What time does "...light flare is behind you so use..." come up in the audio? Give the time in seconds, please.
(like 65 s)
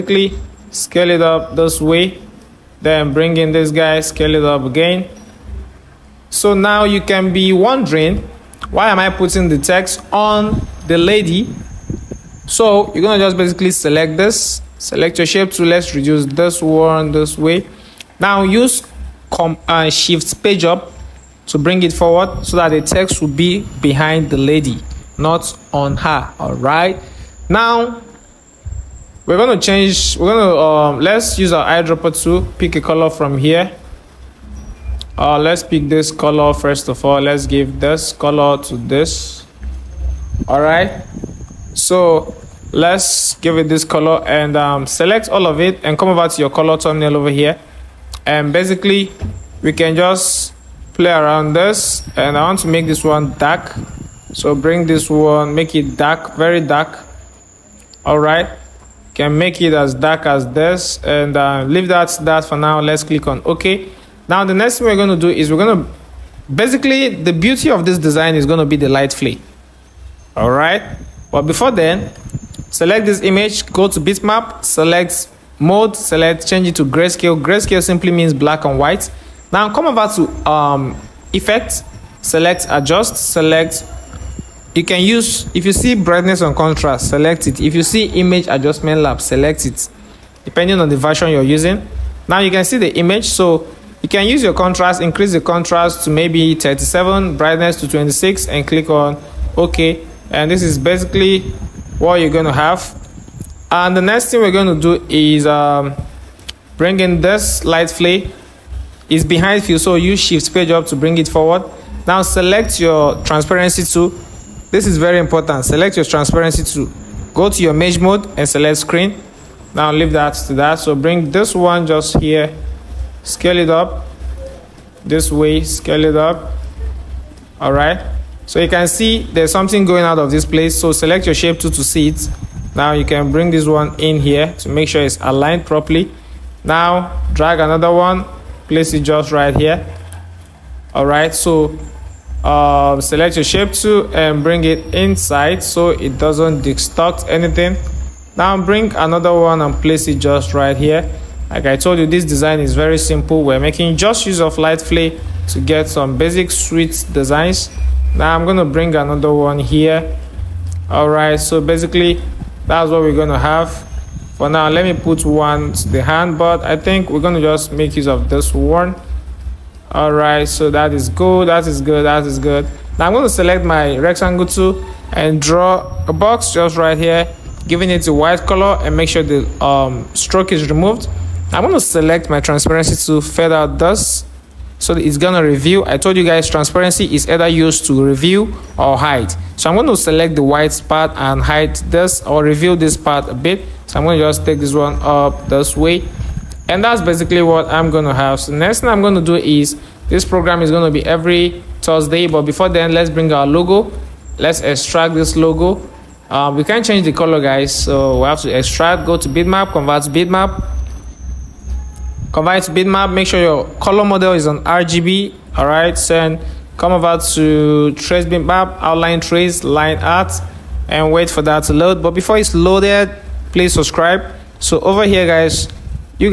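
107 s.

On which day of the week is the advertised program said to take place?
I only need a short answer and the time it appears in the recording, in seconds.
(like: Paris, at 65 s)
Thursday, at 201 s.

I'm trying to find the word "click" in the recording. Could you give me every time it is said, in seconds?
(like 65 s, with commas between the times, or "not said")
63 s, 98 s.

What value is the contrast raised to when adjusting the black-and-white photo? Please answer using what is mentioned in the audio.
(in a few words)
37.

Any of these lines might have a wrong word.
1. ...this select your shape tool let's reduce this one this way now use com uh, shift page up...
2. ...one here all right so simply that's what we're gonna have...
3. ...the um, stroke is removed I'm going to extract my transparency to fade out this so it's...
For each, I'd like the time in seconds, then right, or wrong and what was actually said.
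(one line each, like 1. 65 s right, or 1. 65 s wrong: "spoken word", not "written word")
1. 14 s right
2. 159 s wrong: "basically", not "simply"
3. 179 s wrong: "select", not "extract".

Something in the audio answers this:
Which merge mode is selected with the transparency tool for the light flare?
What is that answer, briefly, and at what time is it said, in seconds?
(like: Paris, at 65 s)
Screen, at 118 s.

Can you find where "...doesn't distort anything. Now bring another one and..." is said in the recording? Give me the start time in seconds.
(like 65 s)
146 s.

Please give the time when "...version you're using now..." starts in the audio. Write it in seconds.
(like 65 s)
90 s.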